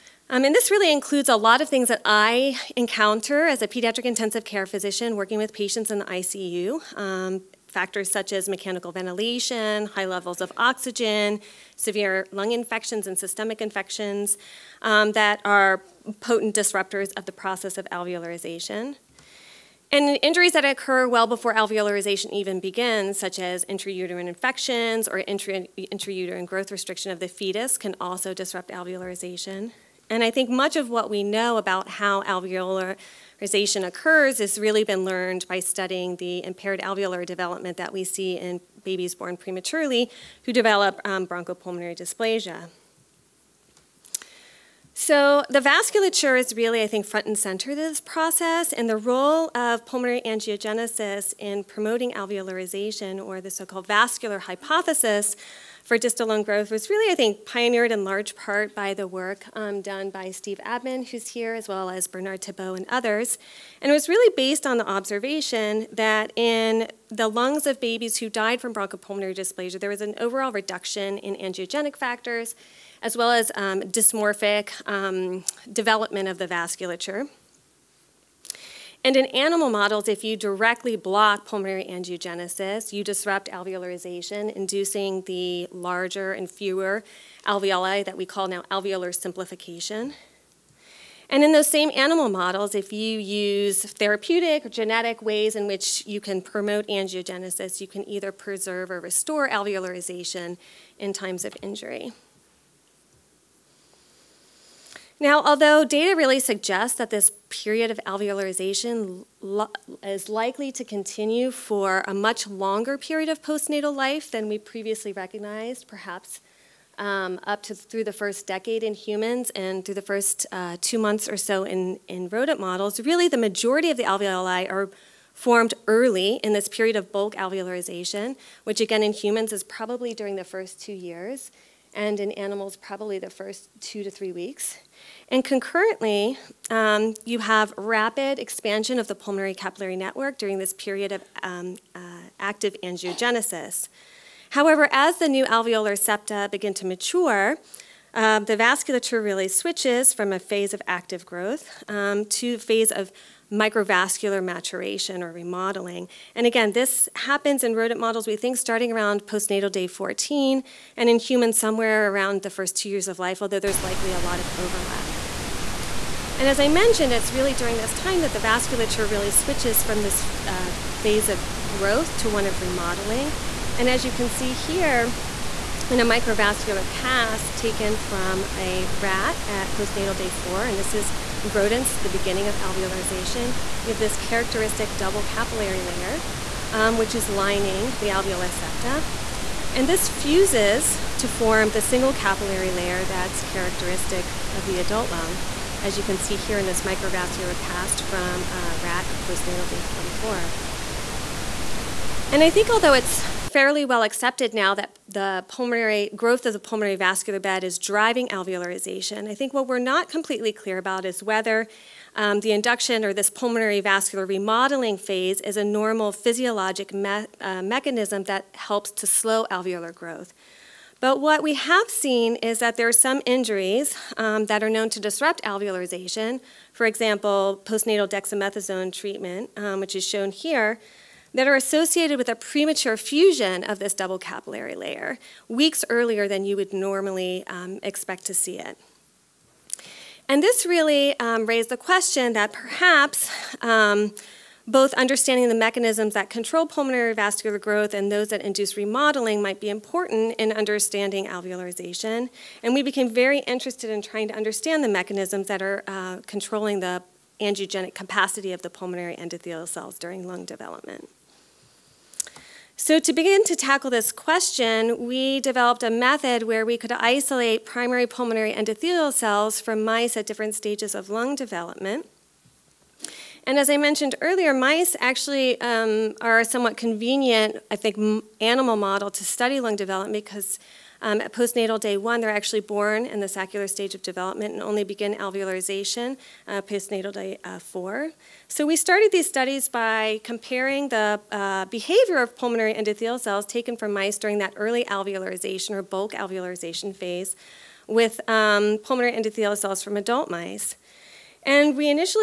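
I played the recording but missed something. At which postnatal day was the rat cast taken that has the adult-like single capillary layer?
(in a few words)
day 44.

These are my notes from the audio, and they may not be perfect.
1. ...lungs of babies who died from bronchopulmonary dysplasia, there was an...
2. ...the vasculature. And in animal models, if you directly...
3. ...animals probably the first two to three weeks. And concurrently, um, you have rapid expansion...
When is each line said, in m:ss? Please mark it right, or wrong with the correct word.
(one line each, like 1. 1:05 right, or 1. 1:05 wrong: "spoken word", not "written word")
1. 1:07 right
2. 1:16 right
3. 2:12 right.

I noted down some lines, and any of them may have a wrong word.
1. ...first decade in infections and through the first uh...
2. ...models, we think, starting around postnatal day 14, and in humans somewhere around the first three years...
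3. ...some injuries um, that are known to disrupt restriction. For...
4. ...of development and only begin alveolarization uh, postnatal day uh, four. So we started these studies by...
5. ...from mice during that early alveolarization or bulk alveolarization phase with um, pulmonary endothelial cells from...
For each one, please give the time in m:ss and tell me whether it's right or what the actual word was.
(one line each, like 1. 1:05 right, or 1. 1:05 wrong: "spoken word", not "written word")
1. 1:58 wrong: "humans", not "infections"
2. 2:37 wrong: "two", not "three"
3. 3:43 wrong: "alveolarization", not "restriction"
4. 4:43 right
5. 4:53 right.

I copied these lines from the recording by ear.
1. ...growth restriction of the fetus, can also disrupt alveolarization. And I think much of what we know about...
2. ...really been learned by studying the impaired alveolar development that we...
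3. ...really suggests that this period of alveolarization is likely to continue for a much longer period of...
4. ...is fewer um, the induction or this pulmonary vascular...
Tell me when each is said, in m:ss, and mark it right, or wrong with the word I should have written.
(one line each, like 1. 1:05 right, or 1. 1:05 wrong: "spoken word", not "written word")
1. 0:26 right
2. 0:34 right
3. 1:46 right
4. 3:31 wrong: "whether", not "fewer".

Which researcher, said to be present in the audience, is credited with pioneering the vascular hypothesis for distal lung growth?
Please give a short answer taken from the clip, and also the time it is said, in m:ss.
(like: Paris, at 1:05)
Steve Abman, at 1:00.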